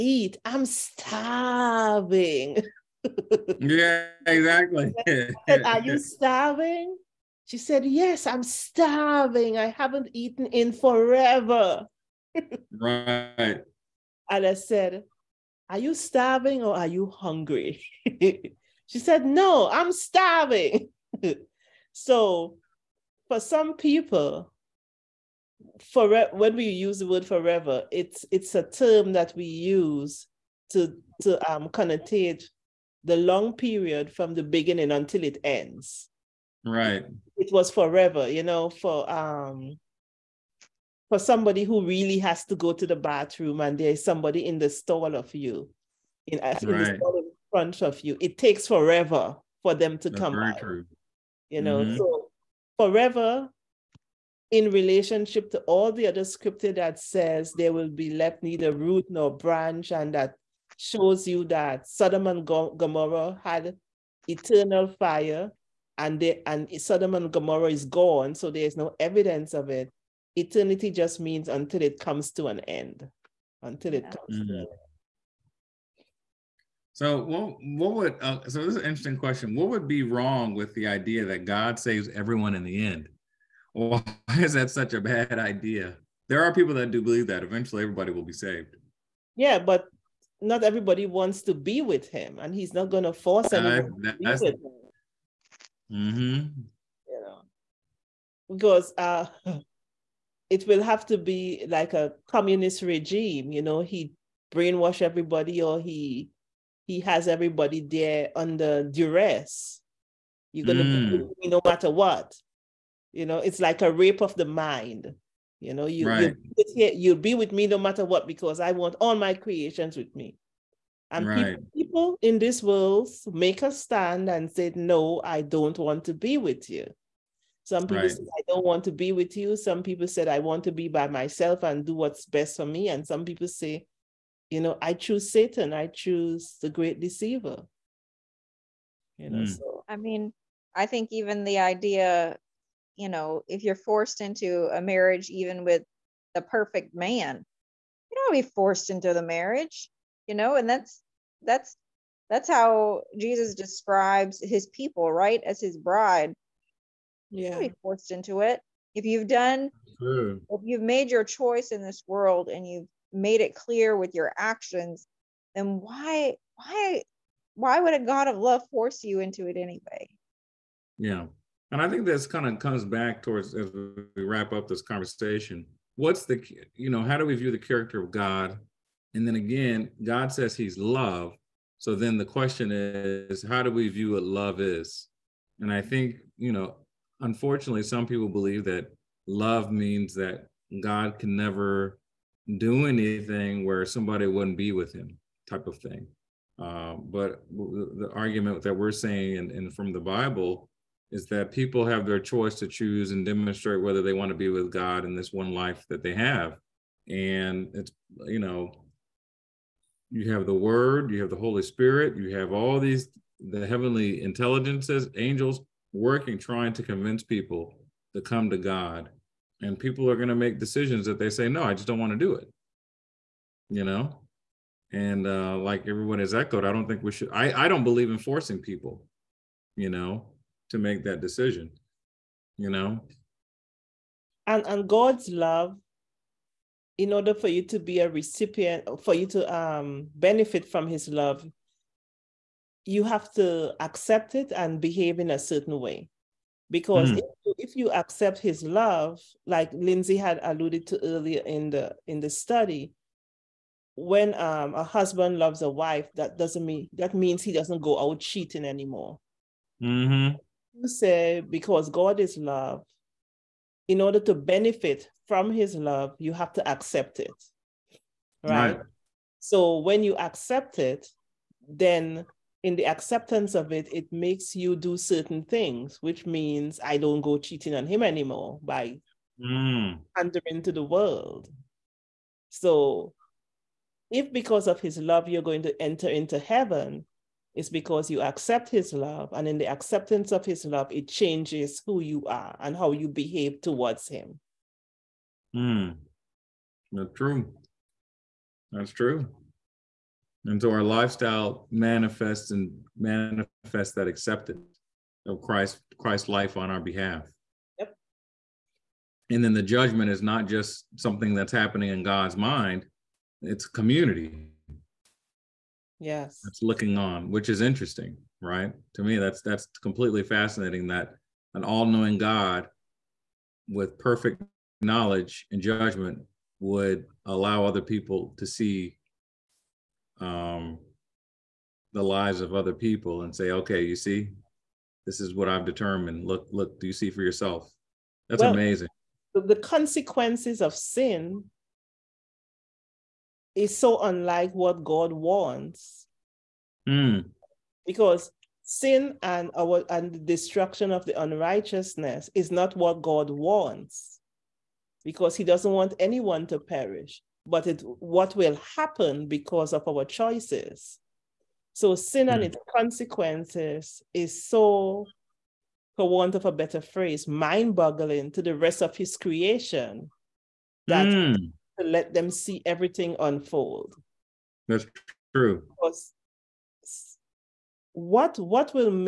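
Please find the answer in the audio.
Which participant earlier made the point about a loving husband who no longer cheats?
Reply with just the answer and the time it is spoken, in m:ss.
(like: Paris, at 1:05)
Lindsay, at 4:09.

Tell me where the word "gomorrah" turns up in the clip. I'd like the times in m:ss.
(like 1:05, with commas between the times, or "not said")
1:02, 1:07.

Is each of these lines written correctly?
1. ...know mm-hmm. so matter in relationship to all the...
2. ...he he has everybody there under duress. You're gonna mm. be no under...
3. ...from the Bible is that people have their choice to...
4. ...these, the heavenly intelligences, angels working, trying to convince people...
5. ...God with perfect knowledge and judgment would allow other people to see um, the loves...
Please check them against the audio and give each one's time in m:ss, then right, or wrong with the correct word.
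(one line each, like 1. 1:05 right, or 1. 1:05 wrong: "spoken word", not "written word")
1. 0:51 wrong: "forever", not "matter"
2. 1:45 wrong: "matter", not "under"
3. 3:19 right
4. 3:32 right
5. 5:22 wrong: "lives", not "loves".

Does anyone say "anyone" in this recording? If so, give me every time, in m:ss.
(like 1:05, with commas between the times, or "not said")
1:33, 5:55.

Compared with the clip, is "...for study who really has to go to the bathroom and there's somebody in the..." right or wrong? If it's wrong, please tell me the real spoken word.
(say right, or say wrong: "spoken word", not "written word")
wrong: "somebody", not "study".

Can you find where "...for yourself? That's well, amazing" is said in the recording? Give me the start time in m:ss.
5:37.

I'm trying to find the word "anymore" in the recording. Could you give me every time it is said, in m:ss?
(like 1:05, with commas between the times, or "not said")
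4:18, 4:38.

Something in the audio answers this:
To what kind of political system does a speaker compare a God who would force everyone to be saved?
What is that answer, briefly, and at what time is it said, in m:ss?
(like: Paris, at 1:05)
A communist regime, at 1:42.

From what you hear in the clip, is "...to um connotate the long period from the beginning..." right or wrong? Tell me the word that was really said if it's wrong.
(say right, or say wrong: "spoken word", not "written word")
right.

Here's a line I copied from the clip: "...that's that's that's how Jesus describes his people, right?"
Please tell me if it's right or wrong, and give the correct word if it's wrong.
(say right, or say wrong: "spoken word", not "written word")
right.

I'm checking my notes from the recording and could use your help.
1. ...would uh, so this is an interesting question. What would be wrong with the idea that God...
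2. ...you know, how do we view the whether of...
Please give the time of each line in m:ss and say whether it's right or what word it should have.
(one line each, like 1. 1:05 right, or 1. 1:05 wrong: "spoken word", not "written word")
1. 1:17 right
2. 2:56 wrong: "character", not "whether".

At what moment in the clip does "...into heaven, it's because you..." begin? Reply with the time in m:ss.
4:46.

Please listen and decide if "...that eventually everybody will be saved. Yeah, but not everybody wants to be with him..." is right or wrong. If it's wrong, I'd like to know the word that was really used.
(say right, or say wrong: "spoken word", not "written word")
right.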